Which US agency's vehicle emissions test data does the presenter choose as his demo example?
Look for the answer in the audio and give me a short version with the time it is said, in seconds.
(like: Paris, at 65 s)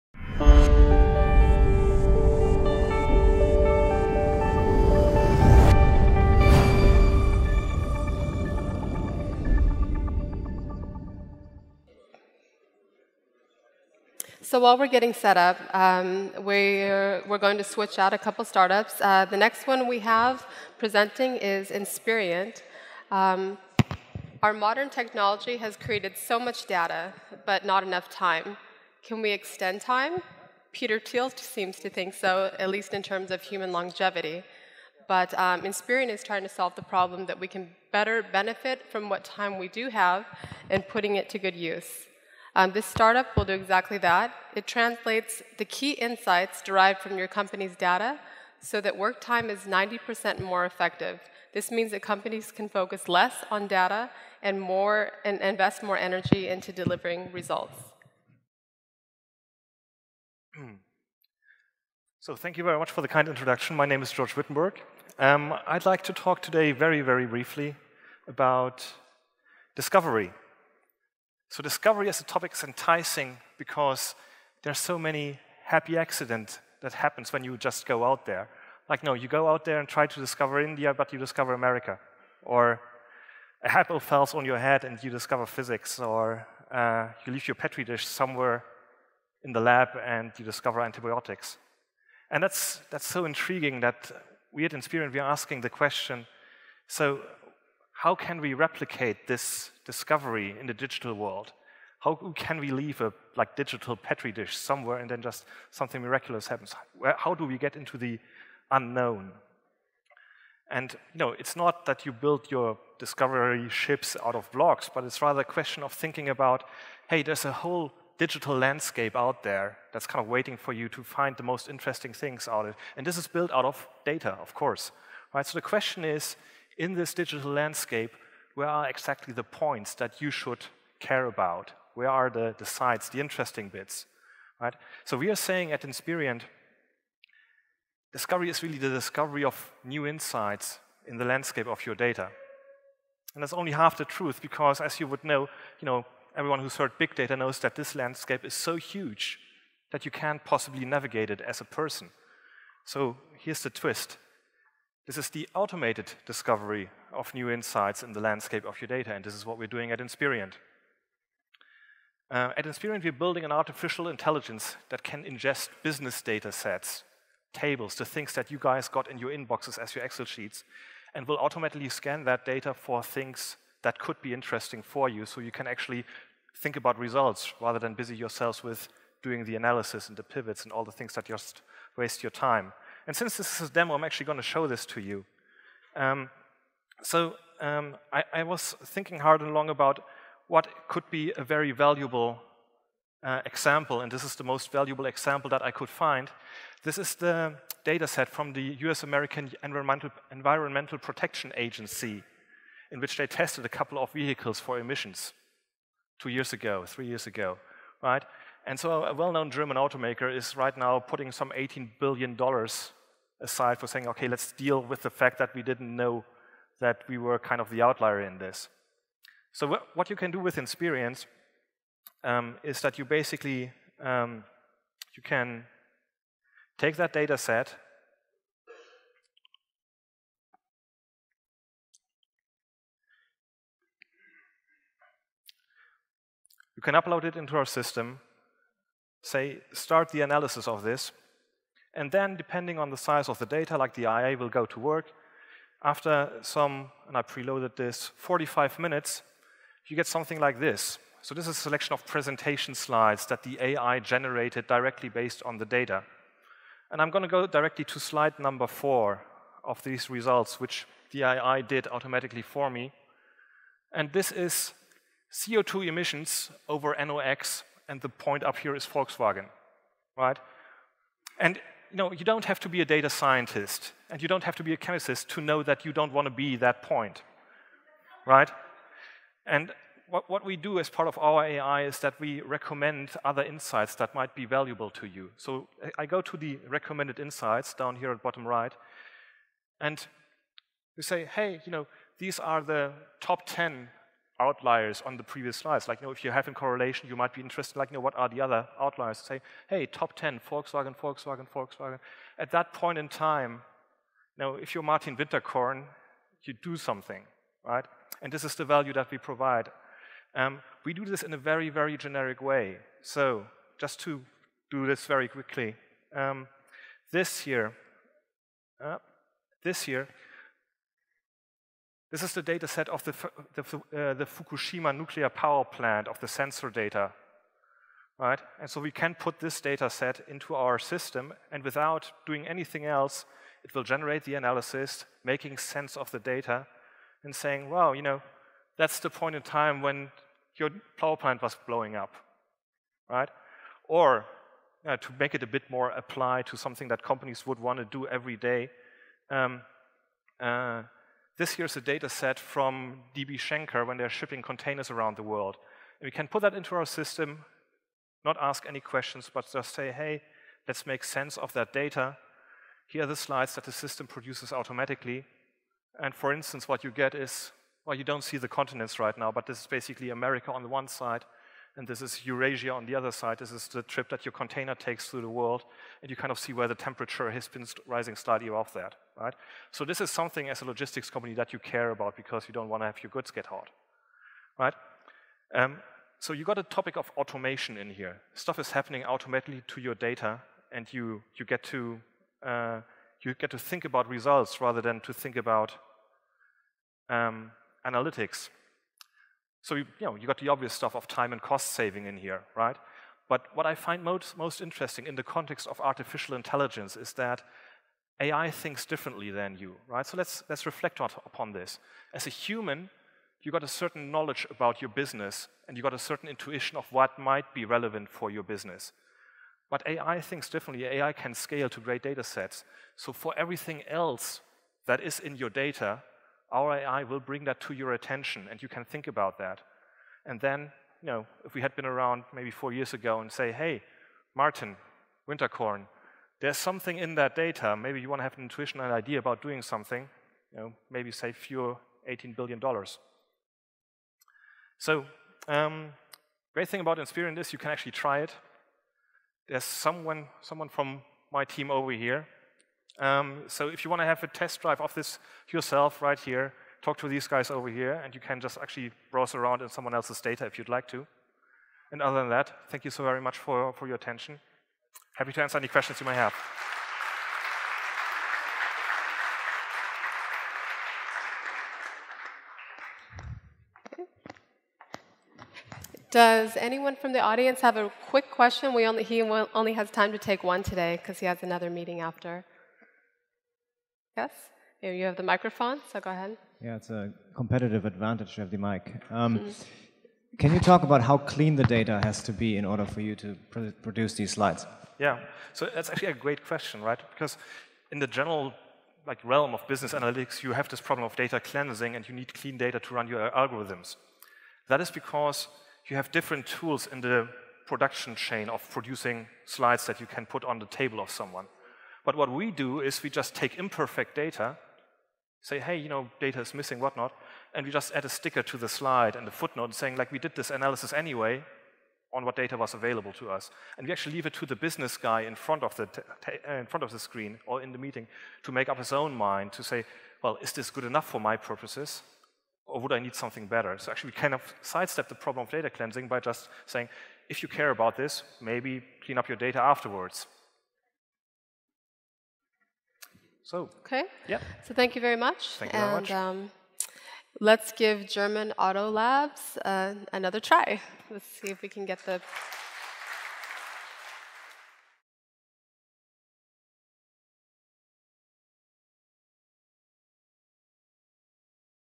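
Environmental Protection Agency, at 200 s.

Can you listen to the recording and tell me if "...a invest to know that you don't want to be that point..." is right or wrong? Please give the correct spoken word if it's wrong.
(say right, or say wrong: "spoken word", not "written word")
wrong: "chemist", not "invest".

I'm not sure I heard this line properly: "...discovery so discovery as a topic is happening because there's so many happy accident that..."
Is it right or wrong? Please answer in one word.
wrong.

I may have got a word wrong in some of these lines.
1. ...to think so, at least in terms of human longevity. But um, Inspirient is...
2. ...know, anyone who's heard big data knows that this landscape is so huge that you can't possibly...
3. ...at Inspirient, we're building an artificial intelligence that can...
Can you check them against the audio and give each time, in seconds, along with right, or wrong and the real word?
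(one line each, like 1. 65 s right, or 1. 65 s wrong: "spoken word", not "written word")
1. 31 s right
2. 145 s wrong: "everyone", not "anyone"
3. 162 s right.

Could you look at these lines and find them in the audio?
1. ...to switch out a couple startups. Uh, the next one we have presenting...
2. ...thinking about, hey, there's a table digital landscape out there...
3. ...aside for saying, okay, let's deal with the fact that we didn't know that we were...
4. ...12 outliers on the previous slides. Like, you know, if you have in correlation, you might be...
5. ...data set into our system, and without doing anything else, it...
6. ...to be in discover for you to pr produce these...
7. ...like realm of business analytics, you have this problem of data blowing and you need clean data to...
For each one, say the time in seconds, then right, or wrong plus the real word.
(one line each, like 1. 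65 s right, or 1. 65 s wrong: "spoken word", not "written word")
1. 17 s right
2. 115 s wrong: "whole", not "table"
3. 213 s right
4. 293 s wrong: "10", not "12"
5. 329 s right
6. 492 s wrong: "order", not "discover"
7. 499 s wrong: "cleansing", not "blowing".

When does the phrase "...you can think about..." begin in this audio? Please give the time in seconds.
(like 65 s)
428 s.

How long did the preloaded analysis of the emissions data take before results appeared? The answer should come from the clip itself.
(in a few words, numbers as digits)
45 minutes.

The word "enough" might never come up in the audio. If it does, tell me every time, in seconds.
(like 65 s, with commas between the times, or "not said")
27 s, 530 s.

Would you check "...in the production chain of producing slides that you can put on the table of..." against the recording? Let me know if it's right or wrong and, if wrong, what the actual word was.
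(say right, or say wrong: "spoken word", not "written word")
right.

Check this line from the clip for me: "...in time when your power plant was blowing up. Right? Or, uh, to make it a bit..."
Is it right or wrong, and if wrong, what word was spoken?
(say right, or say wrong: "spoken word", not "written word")
right.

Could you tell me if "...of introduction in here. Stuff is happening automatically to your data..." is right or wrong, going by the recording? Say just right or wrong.
wrong.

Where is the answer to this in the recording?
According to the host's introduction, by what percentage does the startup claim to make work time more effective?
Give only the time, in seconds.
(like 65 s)
49 s.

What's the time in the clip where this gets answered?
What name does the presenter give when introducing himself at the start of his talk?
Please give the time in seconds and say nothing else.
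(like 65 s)
64 s.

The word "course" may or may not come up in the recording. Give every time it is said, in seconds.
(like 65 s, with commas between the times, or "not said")
124 s.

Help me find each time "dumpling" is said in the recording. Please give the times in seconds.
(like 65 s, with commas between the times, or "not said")
not said.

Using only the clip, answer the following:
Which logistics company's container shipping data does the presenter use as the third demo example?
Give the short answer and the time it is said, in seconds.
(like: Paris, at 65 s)
DB Schenker, at 353 s.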